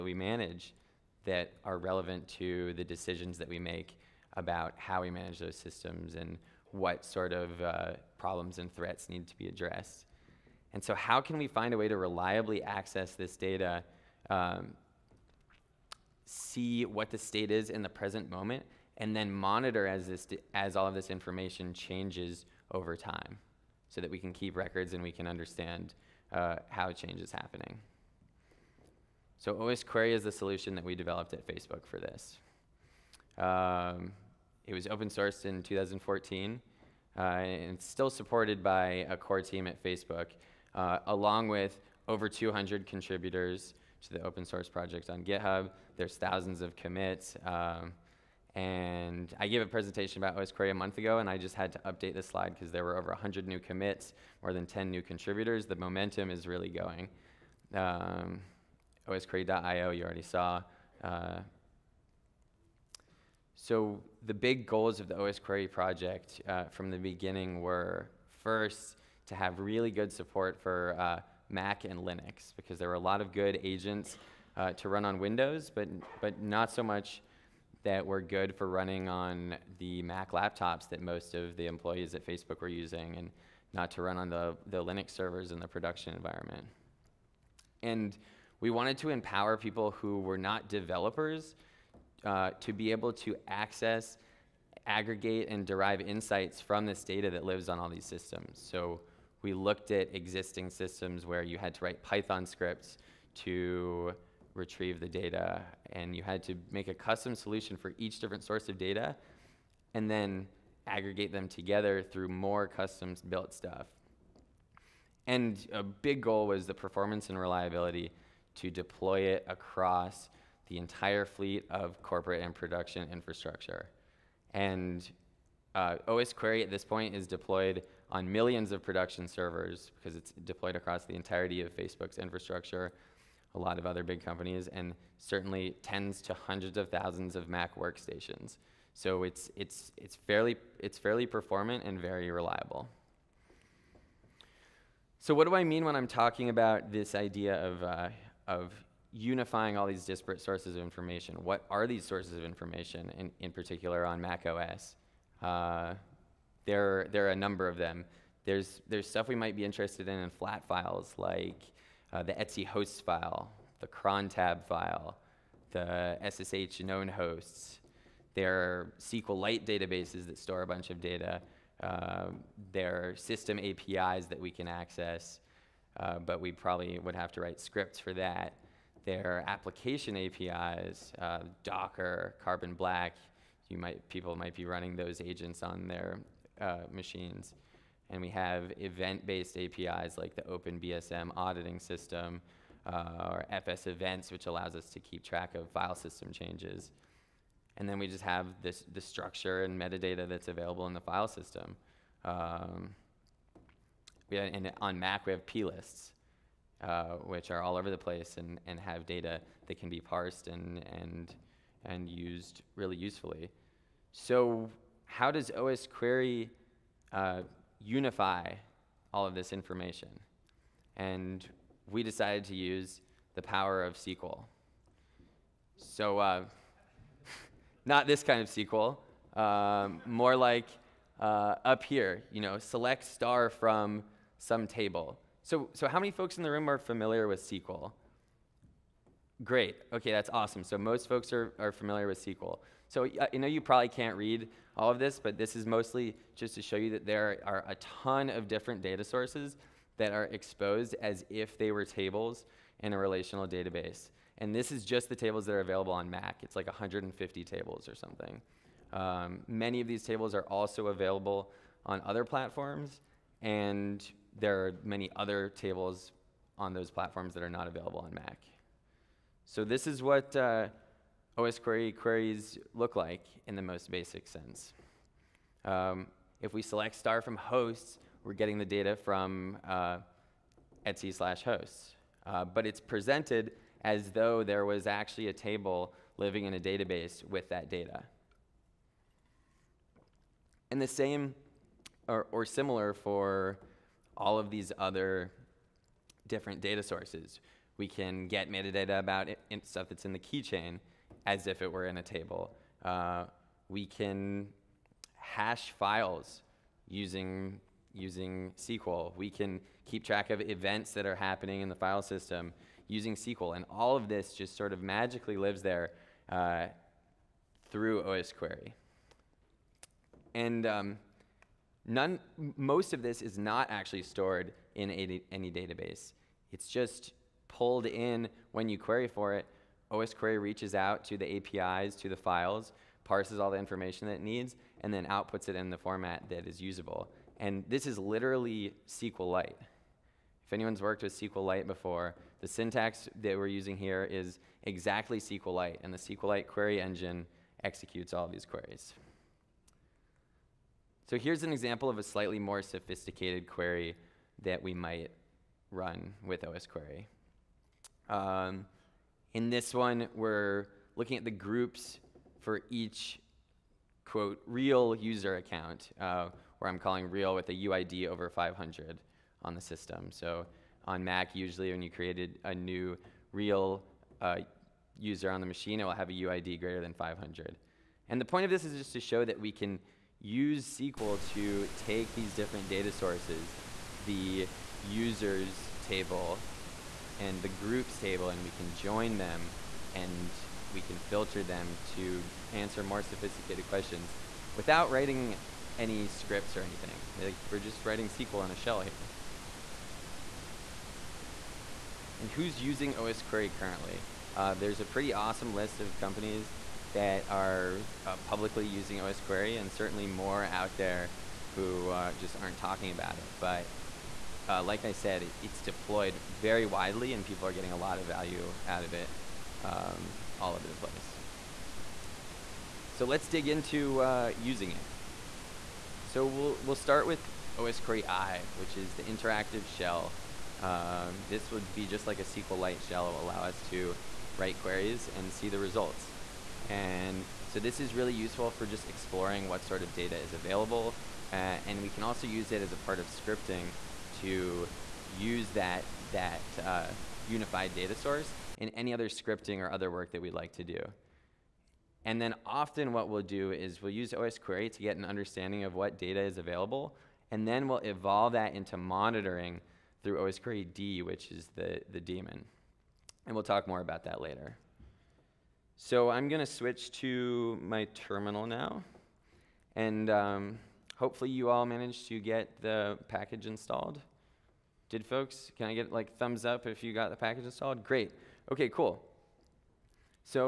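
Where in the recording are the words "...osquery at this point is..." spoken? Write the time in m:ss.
2:06.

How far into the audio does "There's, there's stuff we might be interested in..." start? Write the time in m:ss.
2:38.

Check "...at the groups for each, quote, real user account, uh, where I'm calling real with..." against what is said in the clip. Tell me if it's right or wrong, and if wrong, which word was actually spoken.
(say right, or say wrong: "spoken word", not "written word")
right.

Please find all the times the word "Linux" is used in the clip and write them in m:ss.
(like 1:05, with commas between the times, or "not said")
1:12, 1:24.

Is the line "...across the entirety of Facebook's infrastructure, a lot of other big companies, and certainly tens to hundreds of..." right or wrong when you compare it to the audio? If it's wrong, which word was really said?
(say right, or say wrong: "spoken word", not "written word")
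right.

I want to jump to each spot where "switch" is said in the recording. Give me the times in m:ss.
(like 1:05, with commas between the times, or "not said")
7:46.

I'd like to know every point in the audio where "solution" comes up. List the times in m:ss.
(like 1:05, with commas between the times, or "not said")
0:30, 1:47.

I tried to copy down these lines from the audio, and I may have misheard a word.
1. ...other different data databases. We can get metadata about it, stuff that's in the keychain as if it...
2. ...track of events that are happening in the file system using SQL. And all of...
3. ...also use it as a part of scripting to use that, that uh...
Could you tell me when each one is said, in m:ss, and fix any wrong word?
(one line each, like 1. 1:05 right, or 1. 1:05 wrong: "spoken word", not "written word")
1. 4:54 wrong: "sources", not "databases"
2. 5:10 right
3. 7:22 right.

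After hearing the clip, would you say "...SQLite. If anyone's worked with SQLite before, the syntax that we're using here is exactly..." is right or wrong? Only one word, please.
right.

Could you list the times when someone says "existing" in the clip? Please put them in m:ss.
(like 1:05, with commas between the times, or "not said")
1:40.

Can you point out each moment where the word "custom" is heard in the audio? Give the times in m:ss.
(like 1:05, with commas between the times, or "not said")
1:46, 1:52.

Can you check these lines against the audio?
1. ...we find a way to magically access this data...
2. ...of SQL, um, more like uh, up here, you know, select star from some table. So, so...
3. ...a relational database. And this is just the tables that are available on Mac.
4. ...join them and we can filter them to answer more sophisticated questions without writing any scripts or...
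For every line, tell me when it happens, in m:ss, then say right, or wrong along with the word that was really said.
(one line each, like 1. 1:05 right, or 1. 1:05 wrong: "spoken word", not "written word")
1. 0:11 wrong: "reliably", not "magically"
2. 3:48 right
3. 4:12 right
4. 6:28 right.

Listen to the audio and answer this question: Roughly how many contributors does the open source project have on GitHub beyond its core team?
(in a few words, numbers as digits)
over 200.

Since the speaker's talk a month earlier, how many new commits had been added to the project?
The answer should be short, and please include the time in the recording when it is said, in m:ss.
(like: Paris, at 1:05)
over 100, at 0:52.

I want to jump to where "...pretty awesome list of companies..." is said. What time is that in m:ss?
6:44.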